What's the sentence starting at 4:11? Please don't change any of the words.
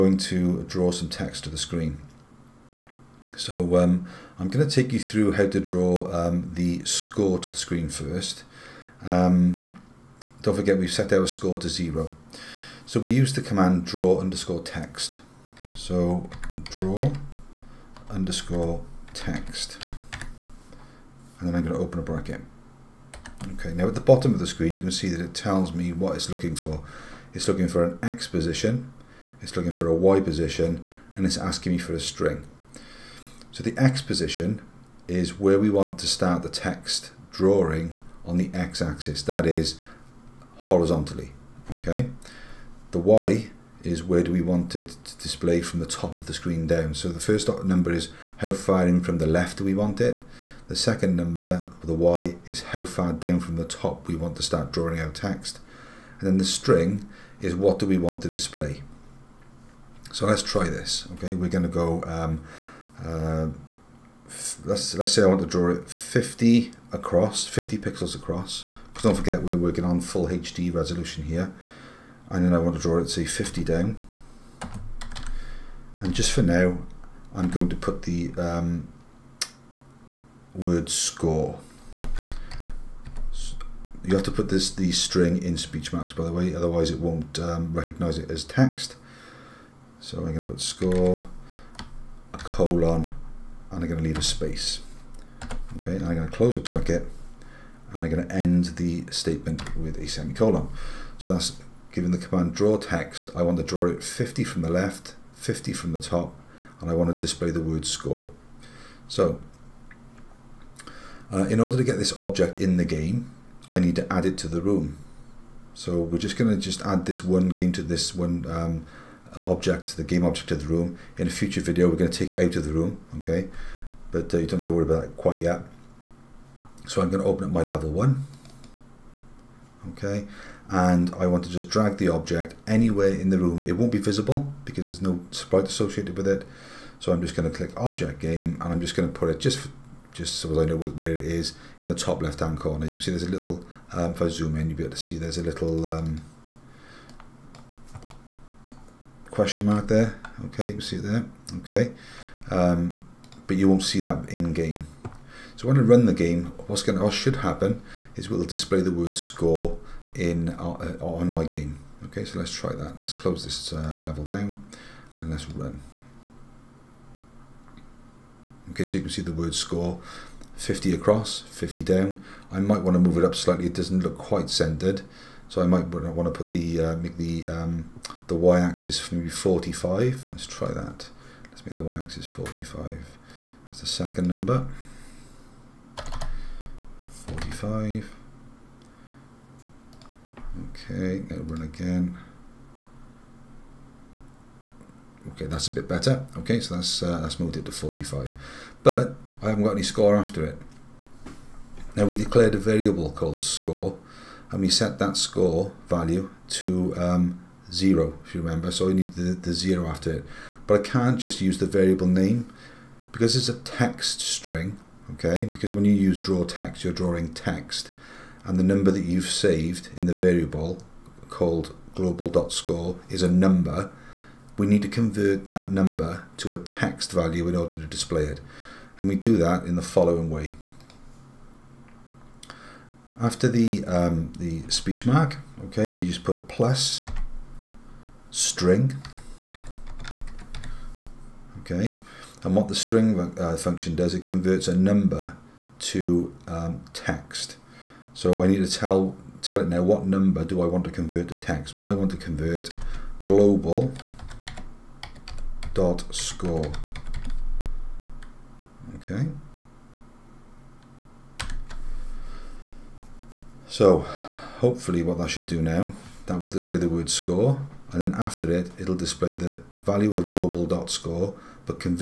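Well, I want to convert global dot score.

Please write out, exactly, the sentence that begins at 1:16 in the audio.
And just for now, I'm going to put the um, word score.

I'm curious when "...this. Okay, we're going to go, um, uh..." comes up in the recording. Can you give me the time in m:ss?
1:00.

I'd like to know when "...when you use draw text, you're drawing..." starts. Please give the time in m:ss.
3:35.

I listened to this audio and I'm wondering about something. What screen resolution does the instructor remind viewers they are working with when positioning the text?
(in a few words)
full HD.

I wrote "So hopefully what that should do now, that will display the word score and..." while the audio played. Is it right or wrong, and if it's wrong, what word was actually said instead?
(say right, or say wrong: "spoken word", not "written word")
right.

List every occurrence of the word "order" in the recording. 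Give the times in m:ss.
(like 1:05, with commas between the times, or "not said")
1:51, 3:47.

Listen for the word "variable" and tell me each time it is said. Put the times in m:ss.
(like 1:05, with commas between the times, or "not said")
3:22, 3:31, 3:40.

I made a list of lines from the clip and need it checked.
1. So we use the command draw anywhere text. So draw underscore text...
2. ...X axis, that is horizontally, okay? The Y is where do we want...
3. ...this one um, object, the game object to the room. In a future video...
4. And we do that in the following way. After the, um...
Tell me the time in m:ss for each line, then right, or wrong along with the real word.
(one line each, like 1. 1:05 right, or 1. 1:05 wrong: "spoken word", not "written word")
1. 0:12 wrong: "underscore", not "anywhere"
2. 0:38 right
3. 1:57 right
4. 3:48 right.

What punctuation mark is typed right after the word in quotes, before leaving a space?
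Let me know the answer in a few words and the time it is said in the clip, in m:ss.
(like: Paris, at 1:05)
colon, at 1:32.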